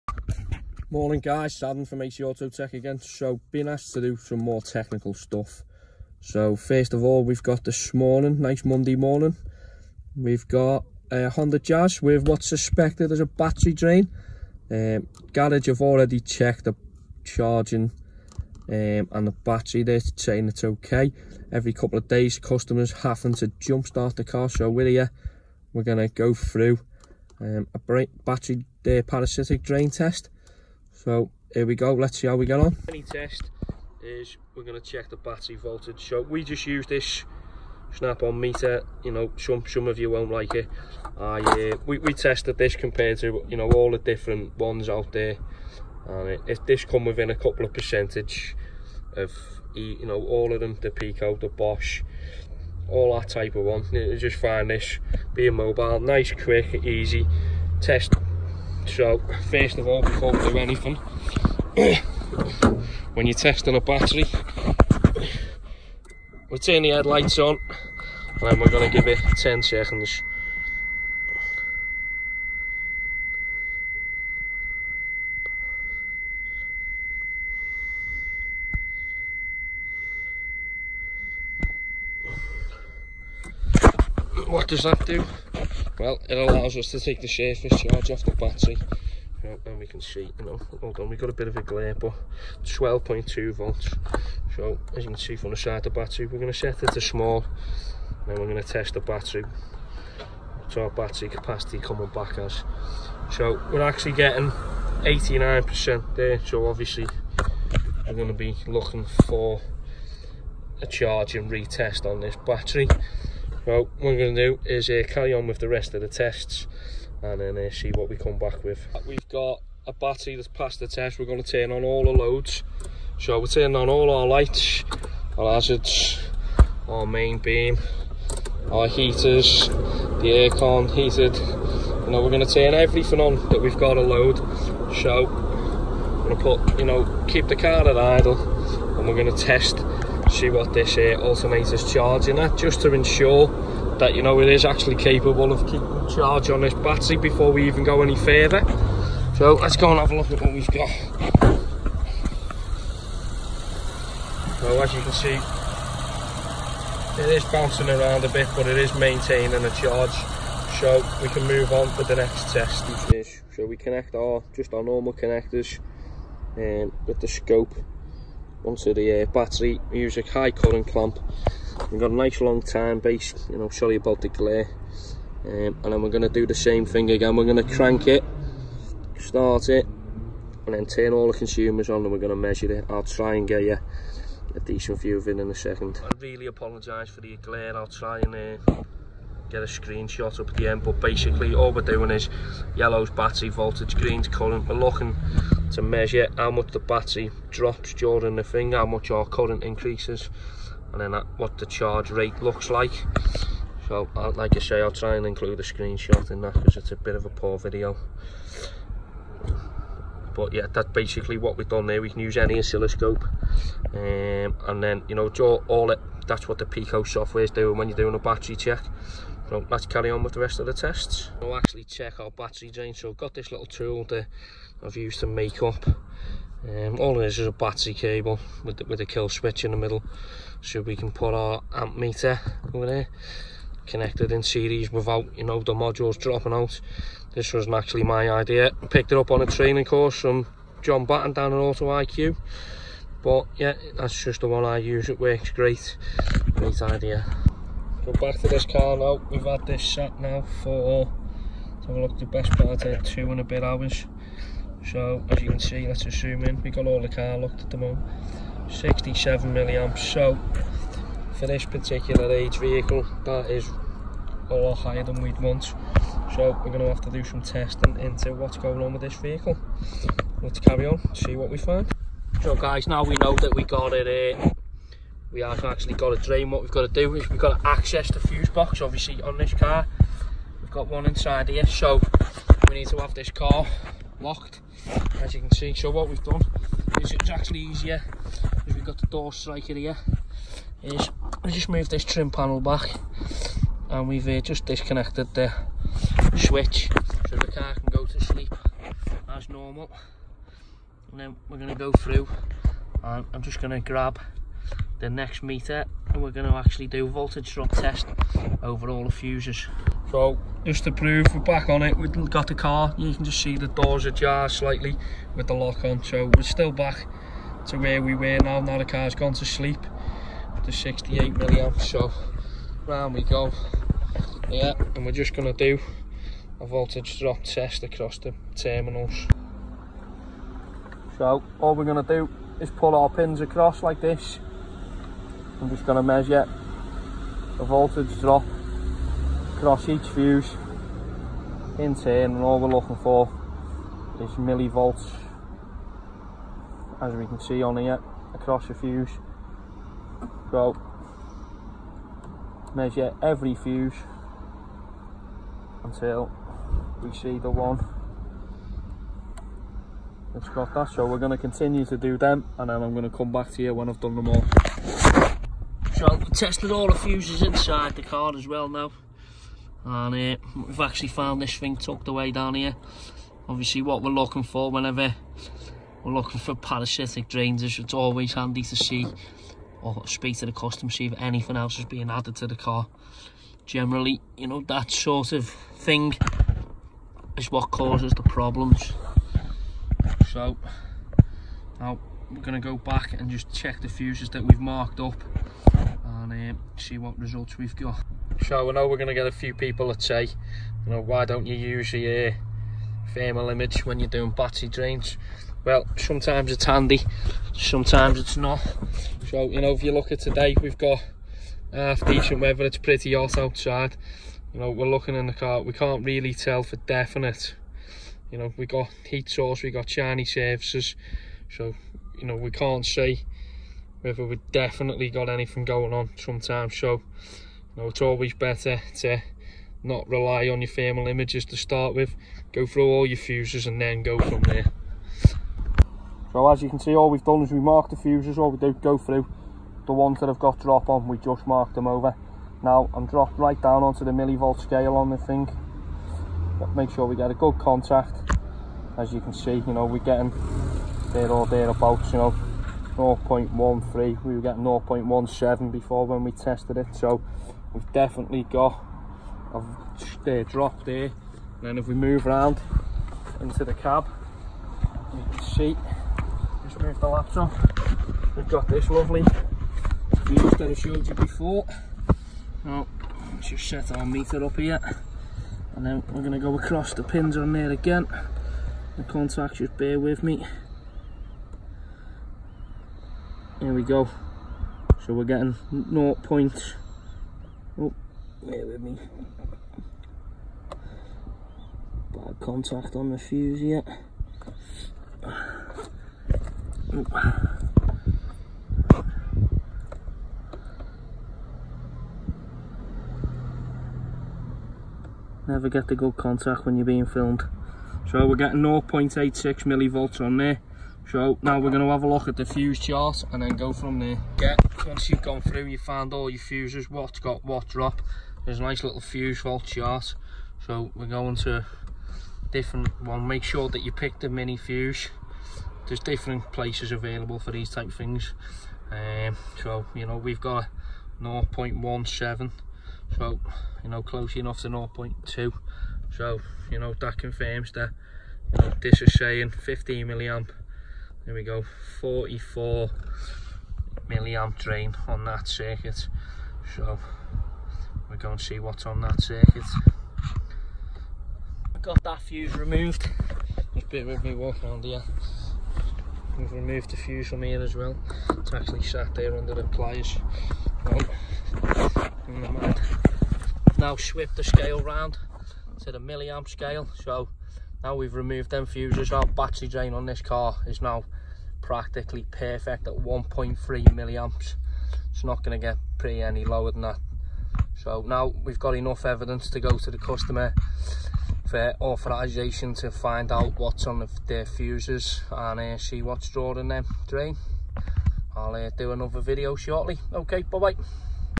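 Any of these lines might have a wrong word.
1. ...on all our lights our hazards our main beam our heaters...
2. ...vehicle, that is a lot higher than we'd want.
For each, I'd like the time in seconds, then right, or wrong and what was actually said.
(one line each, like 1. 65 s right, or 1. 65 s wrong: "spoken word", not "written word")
1. 123 s right
2. 262 s right.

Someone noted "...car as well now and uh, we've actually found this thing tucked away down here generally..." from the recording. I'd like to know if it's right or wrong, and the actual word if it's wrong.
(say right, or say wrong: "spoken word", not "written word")
wrong: "obviously", not "generally".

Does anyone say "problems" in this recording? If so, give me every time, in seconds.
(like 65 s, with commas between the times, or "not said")
388 s.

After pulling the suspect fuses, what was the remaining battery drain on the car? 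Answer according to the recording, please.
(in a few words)
1.3 milliamps.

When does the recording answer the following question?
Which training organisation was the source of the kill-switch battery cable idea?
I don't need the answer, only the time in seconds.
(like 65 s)
241 s.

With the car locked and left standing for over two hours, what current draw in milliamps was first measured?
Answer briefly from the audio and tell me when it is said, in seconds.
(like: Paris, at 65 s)
67 milliamps, at 258 s.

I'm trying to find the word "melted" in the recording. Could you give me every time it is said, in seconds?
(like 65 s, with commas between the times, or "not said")
not said.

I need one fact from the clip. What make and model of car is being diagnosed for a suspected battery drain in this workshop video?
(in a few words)
Honda Jazz.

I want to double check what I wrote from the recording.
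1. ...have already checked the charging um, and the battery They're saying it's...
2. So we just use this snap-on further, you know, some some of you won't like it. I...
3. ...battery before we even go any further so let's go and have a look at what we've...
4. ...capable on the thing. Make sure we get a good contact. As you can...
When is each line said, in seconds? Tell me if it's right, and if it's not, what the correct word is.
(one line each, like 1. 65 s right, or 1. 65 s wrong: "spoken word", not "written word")
1. 15 s right
2. 36 s wrong: "meter", not "further"
3. 146 s right
4. 444 s wrong: "scale", not "capable".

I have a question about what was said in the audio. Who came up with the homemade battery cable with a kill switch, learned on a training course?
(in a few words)
John Batten.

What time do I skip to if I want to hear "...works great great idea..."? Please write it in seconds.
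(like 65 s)
245 s.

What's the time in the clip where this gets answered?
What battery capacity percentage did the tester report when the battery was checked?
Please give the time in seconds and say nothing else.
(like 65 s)
105 s.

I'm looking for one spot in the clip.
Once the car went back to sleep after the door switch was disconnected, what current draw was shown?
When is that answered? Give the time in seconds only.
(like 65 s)
320 s.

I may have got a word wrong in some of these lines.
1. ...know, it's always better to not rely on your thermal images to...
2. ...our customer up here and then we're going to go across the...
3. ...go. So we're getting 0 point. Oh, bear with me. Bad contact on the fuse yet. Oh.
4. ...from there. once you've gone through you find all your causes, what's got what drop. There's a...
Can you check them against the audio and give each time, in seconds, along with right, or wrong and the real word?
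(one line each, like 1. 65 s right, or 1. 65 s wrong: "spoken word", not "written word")
1. 427 s right
2. 473 s wrong: "meter", not "customer"
3. 483 s right
4. 513 s wrong: "fuses", not "causes".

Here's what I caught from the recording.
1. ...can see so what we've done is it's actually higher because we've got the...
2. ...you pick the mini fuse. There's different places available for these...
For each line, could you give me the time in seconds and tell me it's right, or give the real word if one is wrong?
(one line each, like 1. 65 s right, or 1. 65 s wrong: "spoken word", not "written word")
1. 285 s wrong: "easier", not "higher"
2. 523 s right.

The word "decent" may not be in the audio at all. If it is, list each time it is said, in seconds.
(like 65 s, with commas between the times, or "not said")
184 s, 412 s.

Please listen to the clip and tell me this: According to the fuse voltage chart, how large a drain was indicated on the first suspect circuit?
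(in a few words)
44 milliamps.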